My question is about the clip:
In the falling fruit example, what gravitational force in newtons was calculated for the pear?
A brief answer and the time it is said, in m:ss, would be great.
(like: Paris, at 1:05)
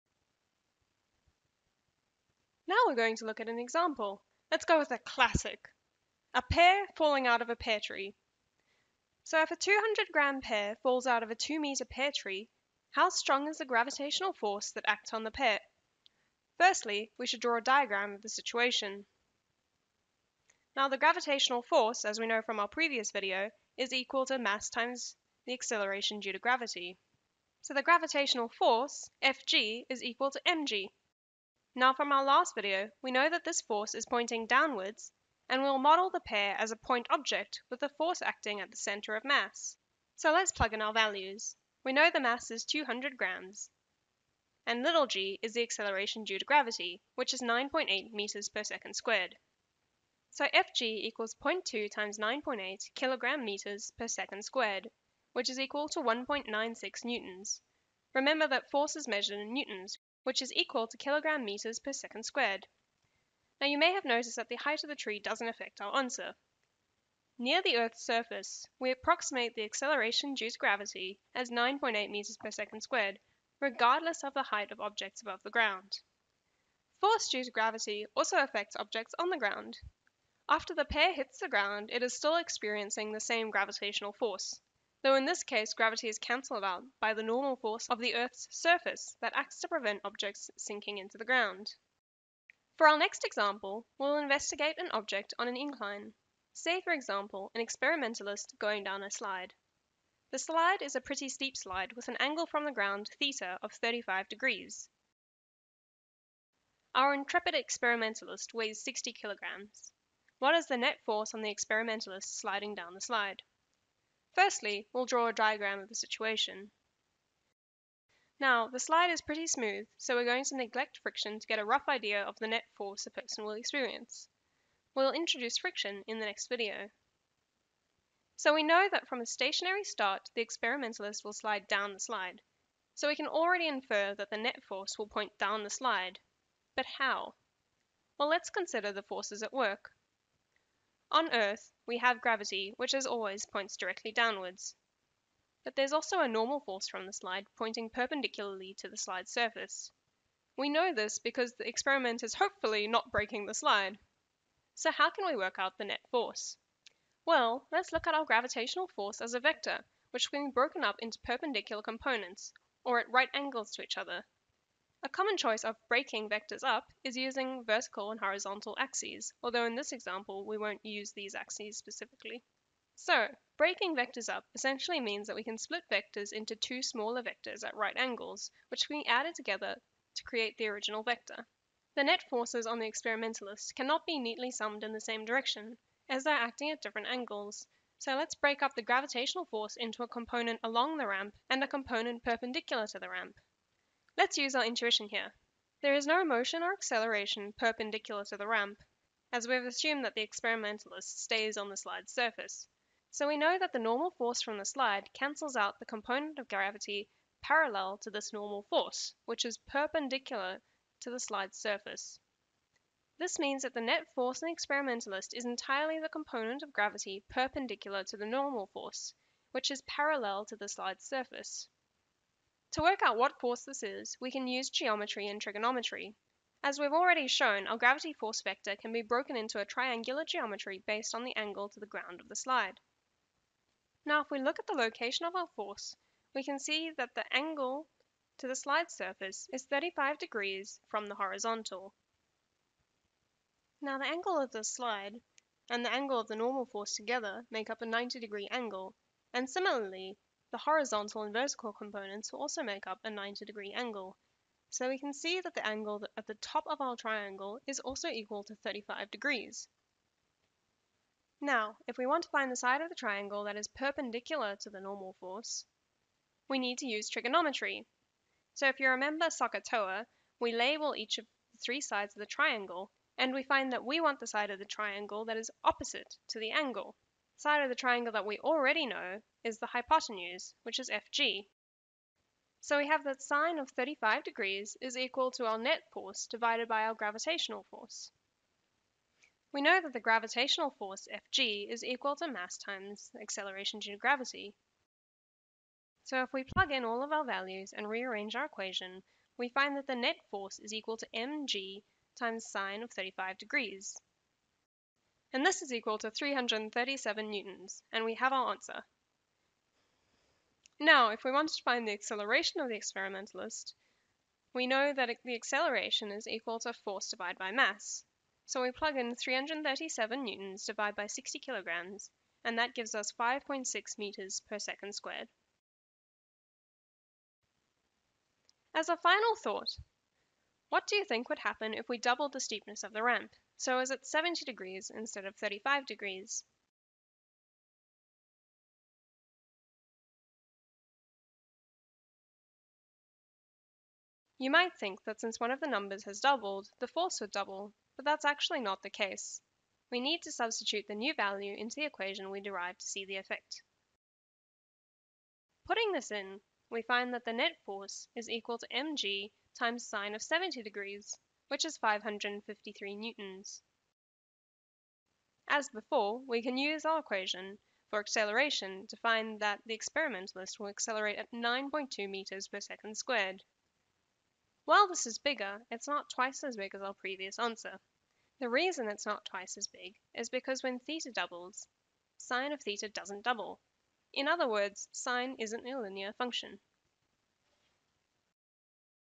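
1.96 newtons, at 0:56.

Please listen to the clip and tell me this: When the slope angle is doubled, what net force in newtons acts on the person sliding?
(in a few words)
553 newtons.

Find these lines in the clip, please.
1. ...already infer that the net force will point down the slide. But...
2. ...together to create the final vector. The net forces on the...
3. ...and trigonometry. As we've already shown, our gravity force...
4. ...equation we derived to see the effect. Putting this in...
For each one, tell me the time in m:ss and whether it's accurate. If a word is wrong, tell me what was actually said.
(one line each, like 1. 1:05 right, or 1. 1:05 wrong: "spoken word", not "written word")
1. 2:13 right
2. 2:59 wrong: "original", not "final"
3. 3:45 right
4. 5:51 right.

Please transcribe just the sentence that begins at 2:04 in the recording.
We'll introduce friction in the next video.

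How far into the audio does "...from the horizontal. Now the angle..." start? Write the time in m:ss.
4:00.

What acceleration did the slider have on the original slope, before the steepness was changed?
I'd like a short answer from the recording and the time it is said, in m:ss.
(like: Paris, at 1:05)
5.6 m/s², at 5:23.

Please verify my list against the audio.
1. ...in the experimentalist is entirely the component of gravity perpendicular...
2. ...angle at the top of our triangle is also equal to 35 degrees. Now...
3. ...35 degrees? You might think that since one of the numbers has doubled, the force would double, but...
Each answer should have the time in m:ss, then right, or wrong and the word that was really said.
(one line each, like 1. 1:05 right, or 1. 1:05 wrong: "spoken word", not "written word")
1. 3:34 right
2. 4:15 right
3. 5:35 right.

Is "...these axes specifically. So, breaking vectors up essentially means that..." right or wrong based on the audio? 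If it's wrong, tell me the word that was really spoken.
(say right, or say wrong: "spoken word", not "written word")
right.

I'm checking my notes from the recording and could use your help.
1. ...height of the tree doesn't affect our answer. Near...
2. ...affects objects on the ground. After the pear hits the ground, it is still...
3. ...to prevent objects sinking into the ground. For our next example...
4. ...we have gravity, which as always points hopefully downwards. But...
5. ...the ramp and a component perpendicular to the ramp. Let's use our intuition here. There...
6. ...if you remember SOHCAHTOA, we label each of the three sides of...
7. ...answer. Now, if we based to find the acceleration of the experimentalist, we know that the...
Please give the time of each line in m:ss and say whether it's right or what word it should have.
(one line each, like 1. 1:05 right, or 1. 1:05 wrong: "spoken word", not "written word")
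1. 1:04 right
2. 1:18 right
3. 1:29 right
4. 2:21 wrong: "directly", not "hopefully"
5. 3:10 right
6. 4:28 right
7. 5:08 wrong: "wanted", not "based".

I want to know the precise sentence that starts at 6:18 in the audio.
The reason it's not twice as big is because when theta doubles, sine of theta doesn't double.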